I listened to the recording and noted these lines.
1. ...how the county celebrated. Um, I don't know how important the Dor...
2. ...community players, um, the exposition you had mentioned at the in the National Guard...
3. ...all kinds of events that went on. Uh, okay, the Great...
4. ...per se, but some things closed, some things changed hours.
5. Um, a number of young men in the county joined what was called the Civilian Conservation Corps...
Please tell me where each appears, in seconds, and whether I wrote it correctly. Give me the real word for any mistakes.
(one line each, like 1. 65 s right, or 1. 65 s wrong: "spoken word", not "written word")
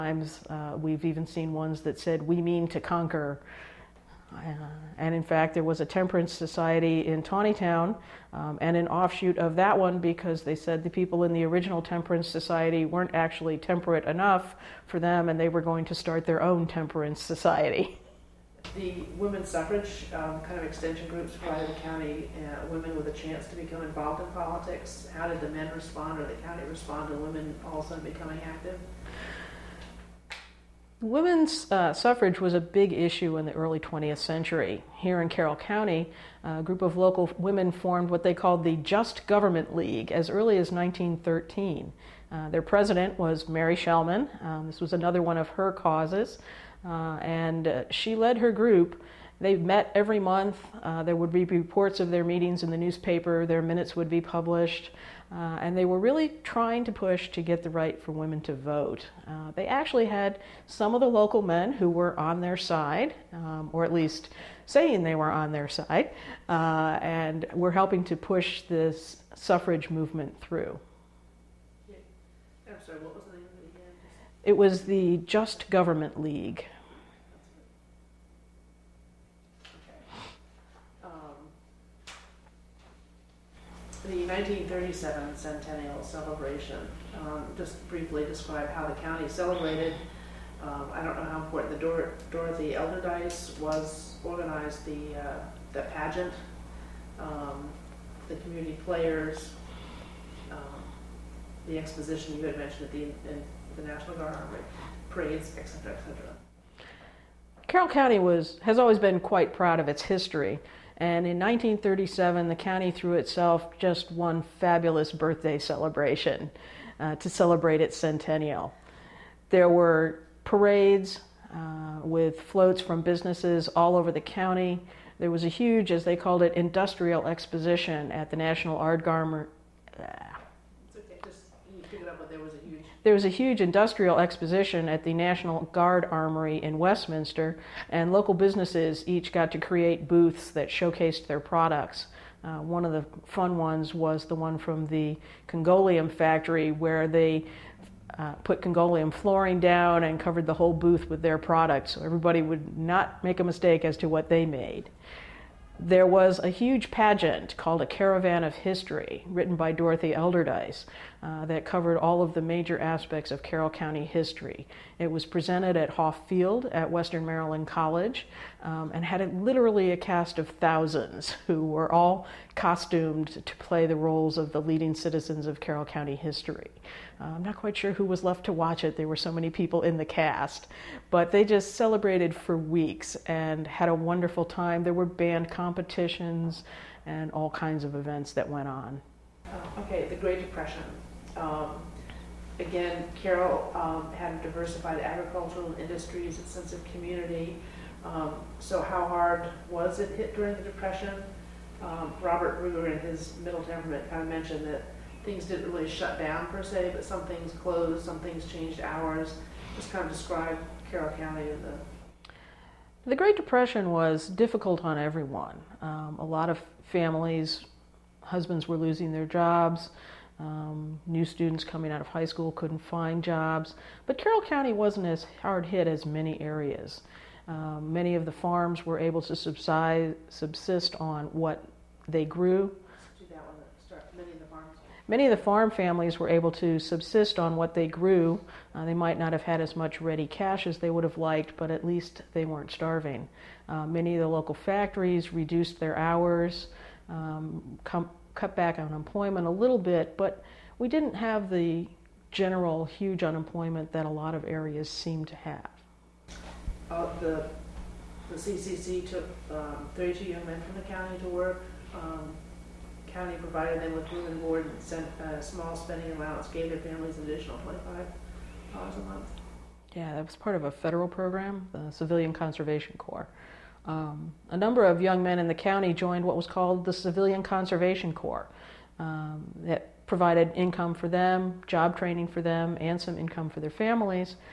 1. 88 s right
2. 98 s right
3. 187 s right
4. 206 s right
5. 273 s right.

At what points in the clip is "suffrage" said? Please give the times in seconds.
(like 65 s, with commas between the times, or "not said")
19 s, 31 s, 69 s.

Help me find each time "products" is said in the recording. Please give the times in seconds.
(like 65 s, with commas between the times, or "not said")
141 s, 151 s.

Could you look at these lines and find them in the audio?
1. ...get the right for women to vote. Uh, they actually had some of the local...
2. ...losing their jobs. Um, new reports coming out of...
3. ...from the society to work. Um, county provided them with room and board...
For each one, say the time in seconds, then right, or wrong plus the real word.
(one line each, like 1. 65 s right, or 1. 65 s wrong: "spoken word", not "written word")
1. 57 s right
2. 218 s wrong: "students", not "reports"
3. 260 s wrong: "county", not "society".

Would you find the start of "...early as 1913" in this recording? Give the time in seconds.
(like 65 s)
40 s.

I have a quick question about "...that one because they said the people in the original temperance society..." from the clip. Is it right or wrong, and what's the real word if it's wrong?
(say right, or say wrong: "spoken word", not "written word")
right.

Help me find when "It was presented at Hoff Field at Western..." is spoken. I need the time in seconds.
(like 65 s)
164 s.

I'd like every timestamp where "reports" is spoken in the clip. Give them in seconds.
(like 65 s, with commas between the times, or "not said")
51 s.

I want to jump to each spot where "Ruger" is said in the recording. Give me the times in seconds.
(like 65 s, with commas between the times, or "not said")
202 s.